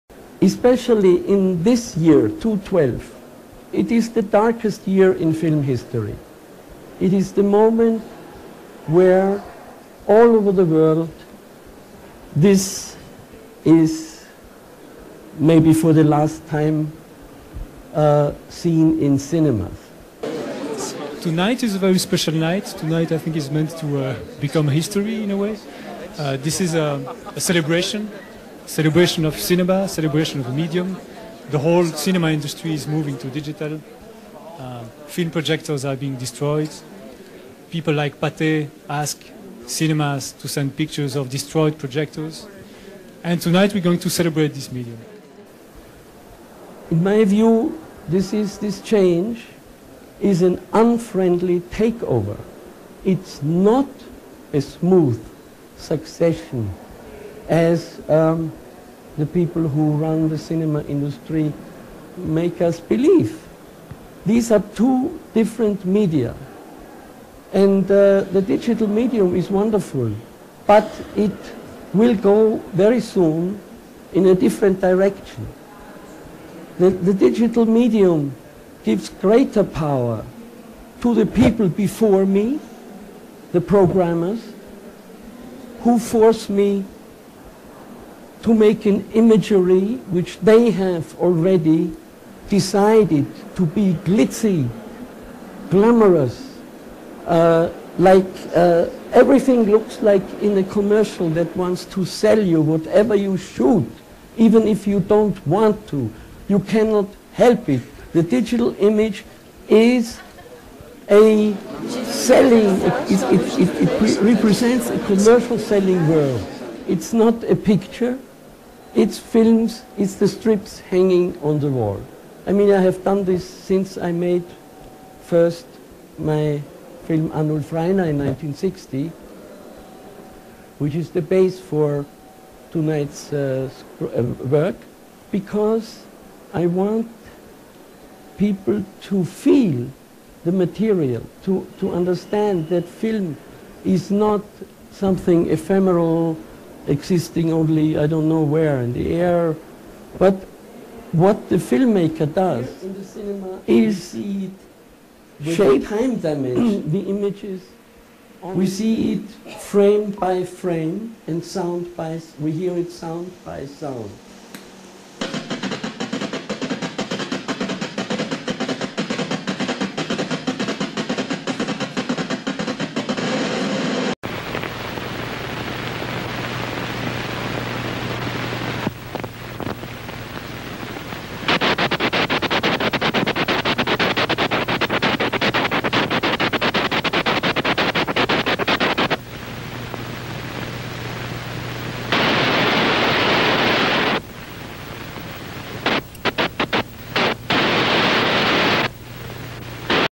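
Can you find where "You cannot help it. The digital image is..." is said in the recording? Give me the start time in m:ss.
1:46.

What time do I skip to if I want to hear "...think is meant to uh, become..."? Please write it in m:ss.
0:23.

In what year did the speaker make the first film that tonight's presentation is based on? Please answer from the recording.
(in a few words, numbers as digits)
1960.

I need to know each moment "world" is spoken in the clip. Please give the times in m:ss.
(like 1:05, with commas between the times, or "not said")
0:10, 1:56.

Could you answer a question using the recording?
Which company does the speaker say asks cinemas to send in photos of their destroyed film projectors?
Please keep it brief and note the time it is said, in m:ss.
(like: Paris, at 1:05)
Pathé, at 0:38.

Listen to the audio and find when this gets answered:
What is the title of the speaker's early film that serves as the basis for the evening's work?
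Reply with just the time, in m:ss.
2:07.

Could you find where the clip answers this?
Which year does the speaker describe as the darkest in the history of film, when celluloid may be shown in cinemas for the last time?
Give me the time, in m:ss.
0:02.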